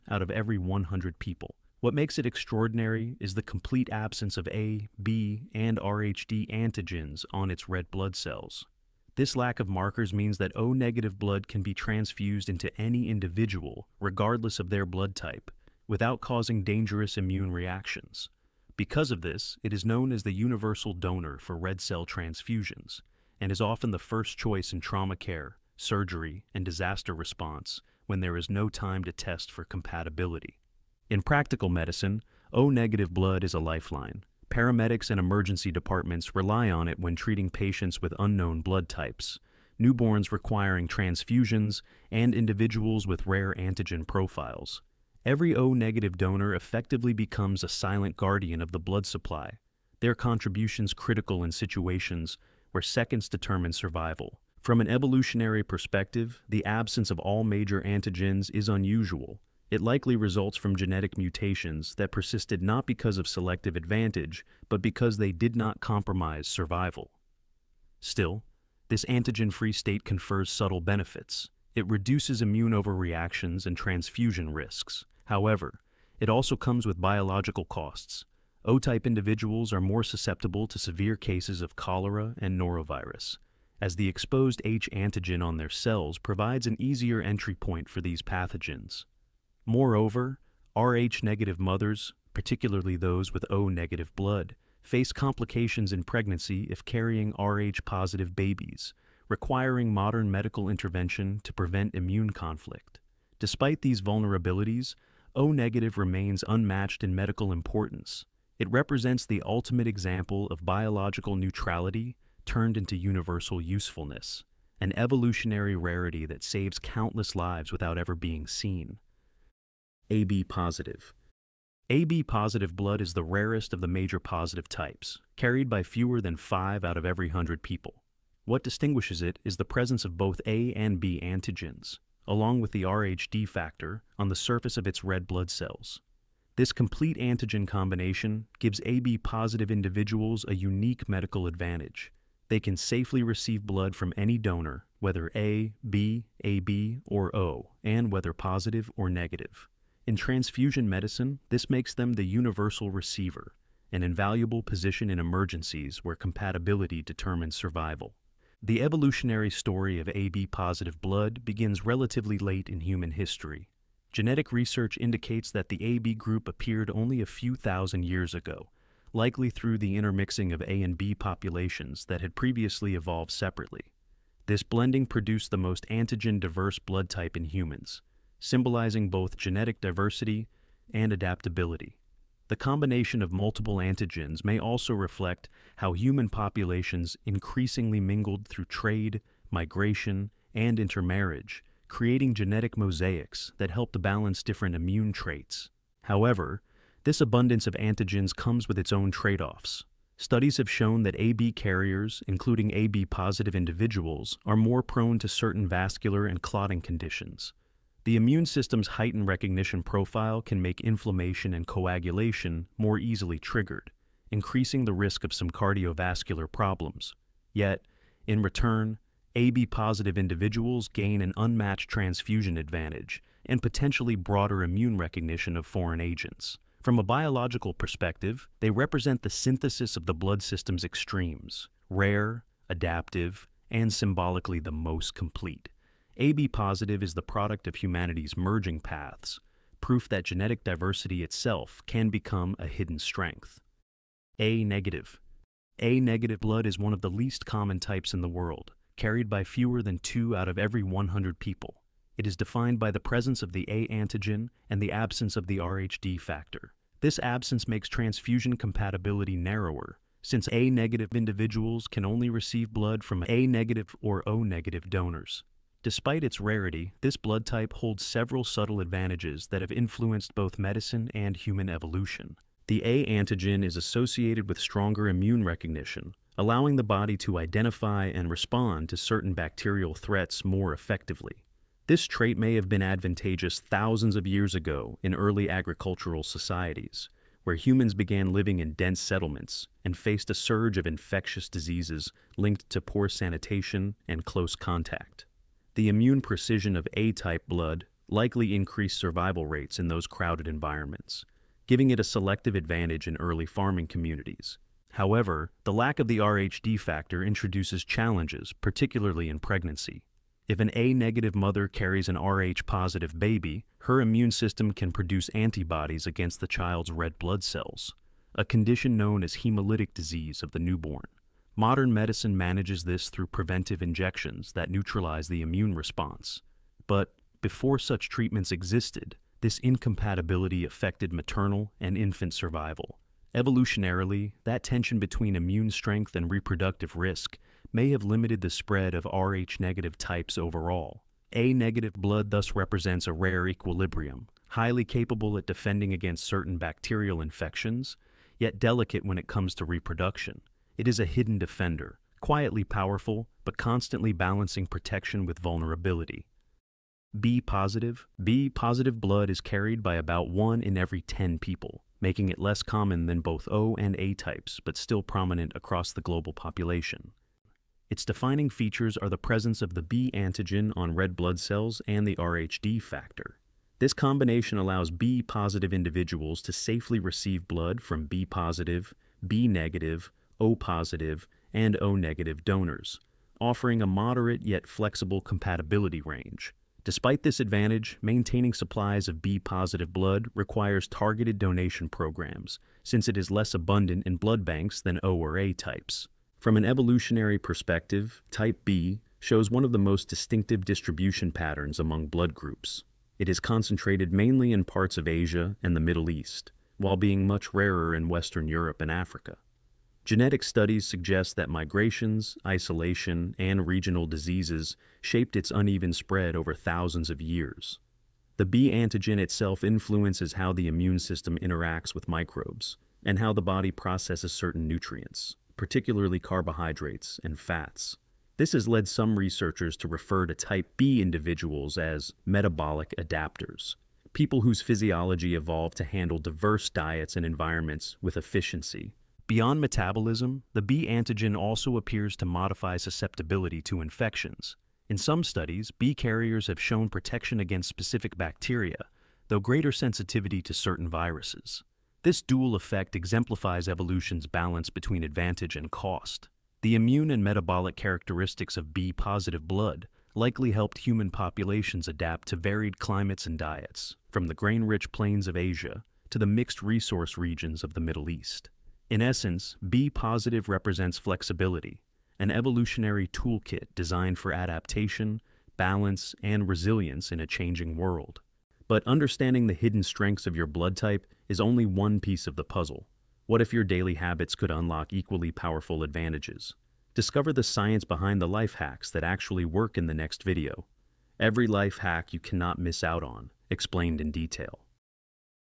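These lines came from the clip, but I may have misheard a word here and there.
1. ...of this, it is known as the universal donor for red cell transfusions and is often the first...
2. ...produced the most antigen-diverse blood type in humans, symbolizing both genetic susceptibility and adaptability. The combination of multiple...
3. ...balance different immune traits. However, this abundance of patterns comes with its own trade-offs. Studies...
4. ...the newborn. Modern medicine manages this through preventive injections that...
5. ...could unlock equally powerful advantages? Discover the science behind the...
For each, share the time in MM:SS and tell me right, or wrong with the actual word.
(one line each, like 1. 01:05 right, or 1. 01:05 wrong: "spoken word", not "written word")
1. 00:19 right
2. 02:55 wrong: "diversity", not "susceptibility"
3. 03:13 wrong: "antigens", not "patterns"
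4. 05:20 right
5. 08:04 right.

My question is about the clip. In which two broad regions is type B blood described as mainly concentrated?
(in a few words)
Asia and the Middle East.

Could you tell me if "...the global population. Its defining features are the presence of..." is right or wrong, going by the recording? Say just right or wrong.
right.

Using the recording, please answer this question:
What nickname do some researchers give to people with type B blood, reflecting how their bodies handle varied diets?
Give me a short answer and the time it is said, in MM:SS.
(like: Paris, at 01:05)
metabolic adapters, at 07:12.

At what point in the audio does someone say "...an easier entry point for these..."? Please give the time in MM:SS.
01:26.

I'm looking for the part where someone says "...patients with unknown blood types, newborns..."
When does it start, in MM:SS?
00:37.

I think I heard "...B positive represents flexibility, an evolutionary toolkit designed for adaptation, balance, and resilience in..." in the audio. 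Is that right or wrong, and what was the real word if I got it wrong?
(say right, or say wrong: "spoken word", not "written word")
right.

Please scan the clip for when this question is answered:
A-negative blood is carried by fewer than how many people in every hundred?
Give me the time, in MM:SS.
04:09.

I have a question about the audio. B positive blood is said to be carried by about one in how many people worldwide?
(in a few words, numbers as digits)
10.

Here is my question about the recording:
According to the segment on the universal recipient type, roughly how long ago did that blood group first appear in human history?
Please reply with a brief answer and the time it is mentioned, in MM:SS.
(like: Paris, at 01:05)
a few thousand years ago, at 02:47.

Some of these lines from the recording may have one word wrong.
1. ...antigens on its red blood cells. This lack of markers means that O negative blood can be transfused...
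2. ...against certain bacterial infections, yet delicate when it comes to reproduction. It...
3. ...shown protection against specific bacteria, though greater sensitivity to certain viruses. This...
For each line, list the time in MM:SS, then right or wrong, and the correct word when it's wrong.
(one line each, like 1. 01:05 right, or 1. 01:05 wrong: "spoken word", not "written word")
1. 00:06 right
2. 05:45 right
3. 07:26 right.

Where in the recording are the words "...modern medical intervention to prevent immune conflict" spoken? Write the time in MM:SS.
01:39.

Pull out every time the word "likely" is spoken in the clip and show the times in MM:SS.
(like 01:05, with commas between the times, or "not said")
00:59, 02:49, 04:58, 07:40.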